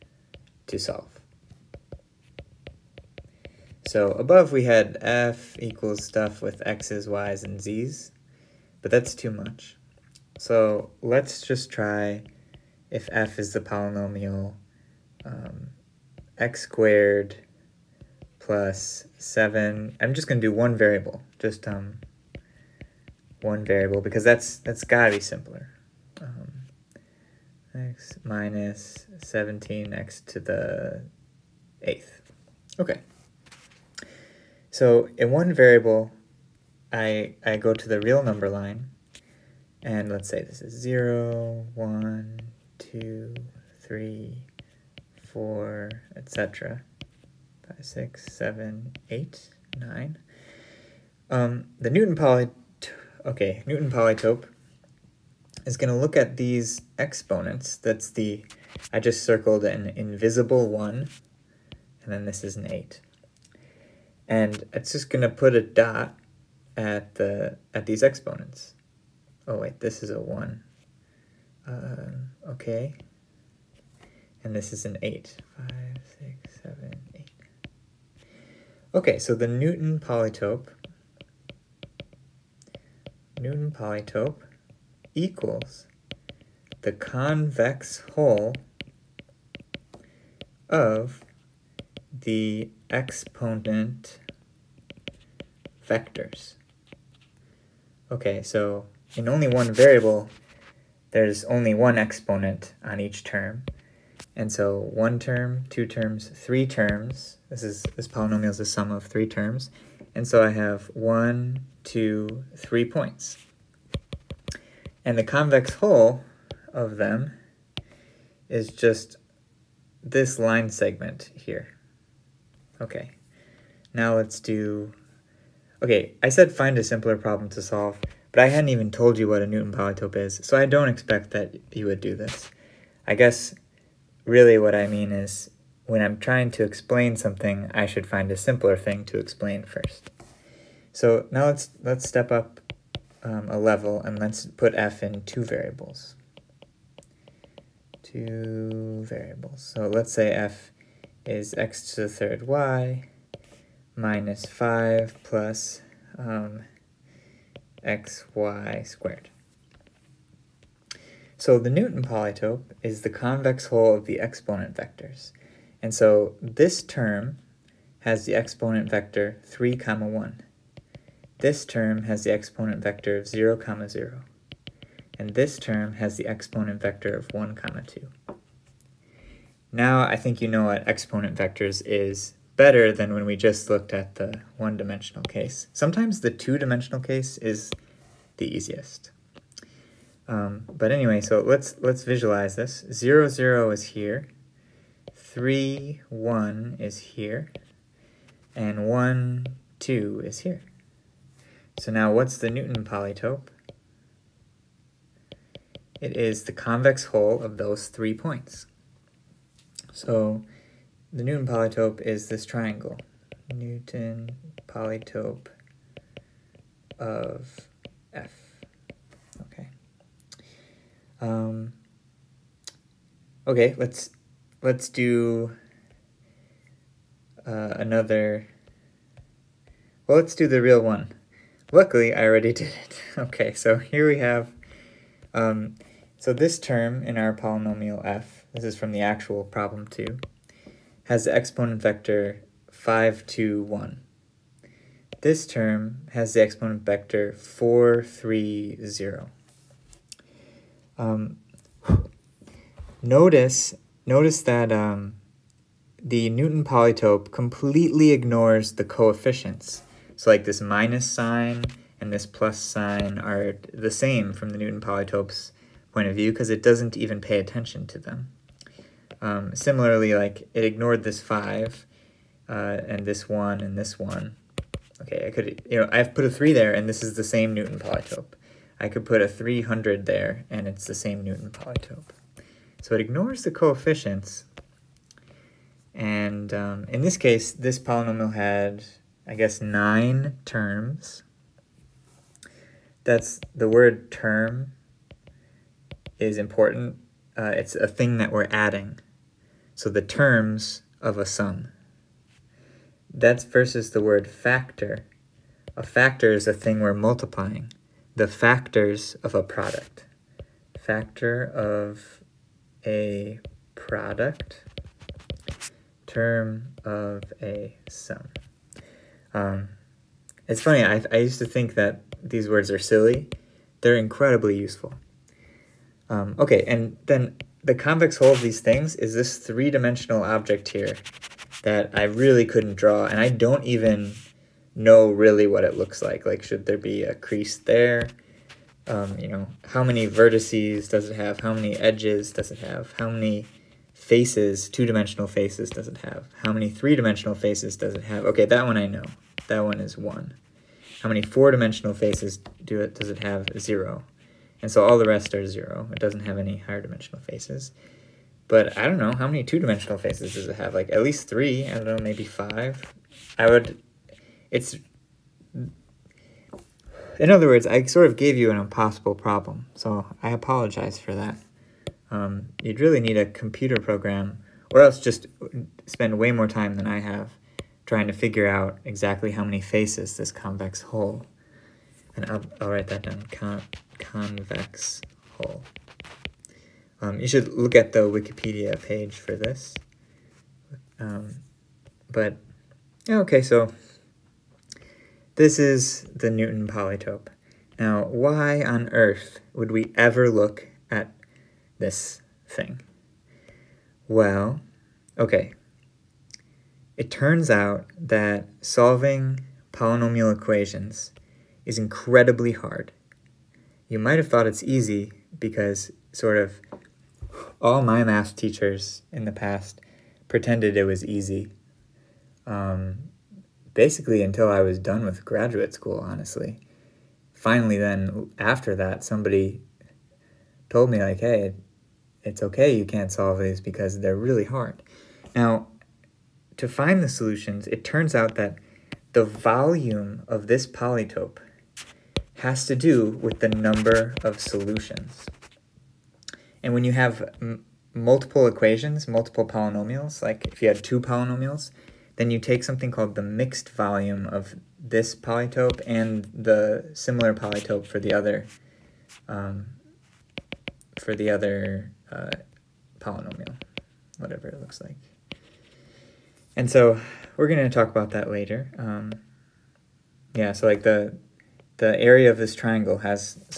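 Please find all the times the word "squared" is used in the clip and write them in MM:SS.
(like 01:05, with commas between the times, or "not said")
00:16, 02:38.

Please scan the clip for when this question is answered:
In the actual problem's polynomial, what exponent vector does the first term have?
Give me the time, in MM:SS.
04:02.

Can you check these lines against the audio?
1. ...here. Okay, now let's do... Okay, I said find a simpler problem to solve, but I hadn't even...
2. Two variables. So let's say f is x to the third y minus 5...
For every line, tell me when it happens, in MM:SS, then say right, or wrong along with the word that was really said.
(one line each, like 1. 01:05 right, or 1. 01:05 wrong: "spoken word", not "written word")
1. 02:01 right
2. 02:28 right.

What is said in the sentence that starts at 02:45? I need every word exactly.
And so this term has the exponent vector 3 comma 1.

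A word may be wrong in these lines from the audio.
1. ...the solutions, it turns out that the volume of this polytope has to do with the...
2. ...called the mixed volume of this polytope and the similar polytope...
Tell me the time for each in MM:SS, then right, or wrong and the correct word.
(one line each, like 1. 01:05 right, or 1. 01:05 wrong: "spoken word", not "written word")
1. 07:17 right
2. 07:32 right.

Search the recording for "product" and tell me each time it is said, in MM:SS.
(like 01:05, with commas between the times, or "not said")
05:09, 05:13.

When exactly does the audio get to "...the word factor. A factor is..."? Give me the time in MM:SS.
05:03.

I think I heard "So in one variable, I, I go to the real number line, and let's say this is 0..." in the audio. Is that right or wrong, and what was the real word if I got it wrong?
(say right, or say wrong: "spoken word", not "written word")
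right.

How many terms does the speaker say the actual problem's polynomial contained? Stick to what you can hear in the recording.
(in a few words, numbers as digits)
9.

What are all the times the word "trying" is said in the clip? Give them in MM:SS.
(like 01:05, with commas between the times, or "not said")
02:16, 06:17.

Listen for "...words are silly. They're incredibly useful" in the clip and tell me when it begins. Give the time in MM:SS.
05:22.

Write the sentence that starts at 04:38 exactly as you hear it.
I could put a 300 there and it's the same Newton polytope.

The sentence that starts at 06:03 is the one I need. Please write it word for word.
I would, it's in other words, I sort of gave you an impossible problem, so I apologize for that.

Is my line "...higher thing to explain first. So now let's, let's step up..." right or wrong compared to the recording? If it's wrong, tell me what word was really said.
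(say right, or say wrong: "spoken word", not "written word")
wrong: "simpler", not "higher".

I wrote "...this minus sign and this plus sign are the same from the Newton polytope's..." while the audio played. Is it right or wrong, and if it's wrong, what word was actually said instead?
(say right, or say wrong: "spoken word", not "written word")
right.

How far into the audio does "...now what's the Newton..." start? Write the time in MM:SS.
03:21.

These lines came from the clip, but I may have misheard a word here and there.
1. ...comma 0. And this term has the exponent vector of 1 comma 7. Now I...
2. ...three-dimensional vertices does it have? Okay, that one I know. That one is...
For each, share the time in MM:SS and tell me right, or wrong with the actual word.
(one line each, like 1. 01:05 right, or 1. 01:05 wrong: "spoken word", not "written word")
1. 02:53 wrong: "2", not "7"
2. 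05:46 wrong: "faces", not "vertices".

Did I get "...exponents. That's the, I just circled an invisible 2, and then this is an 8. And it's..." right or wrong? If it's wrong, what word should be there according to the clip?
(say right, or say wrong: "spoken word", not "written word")
wrong: "1", not "2".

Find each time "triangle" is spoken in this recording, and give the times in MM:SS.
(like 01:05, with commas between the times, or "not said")
03:32, 07:52.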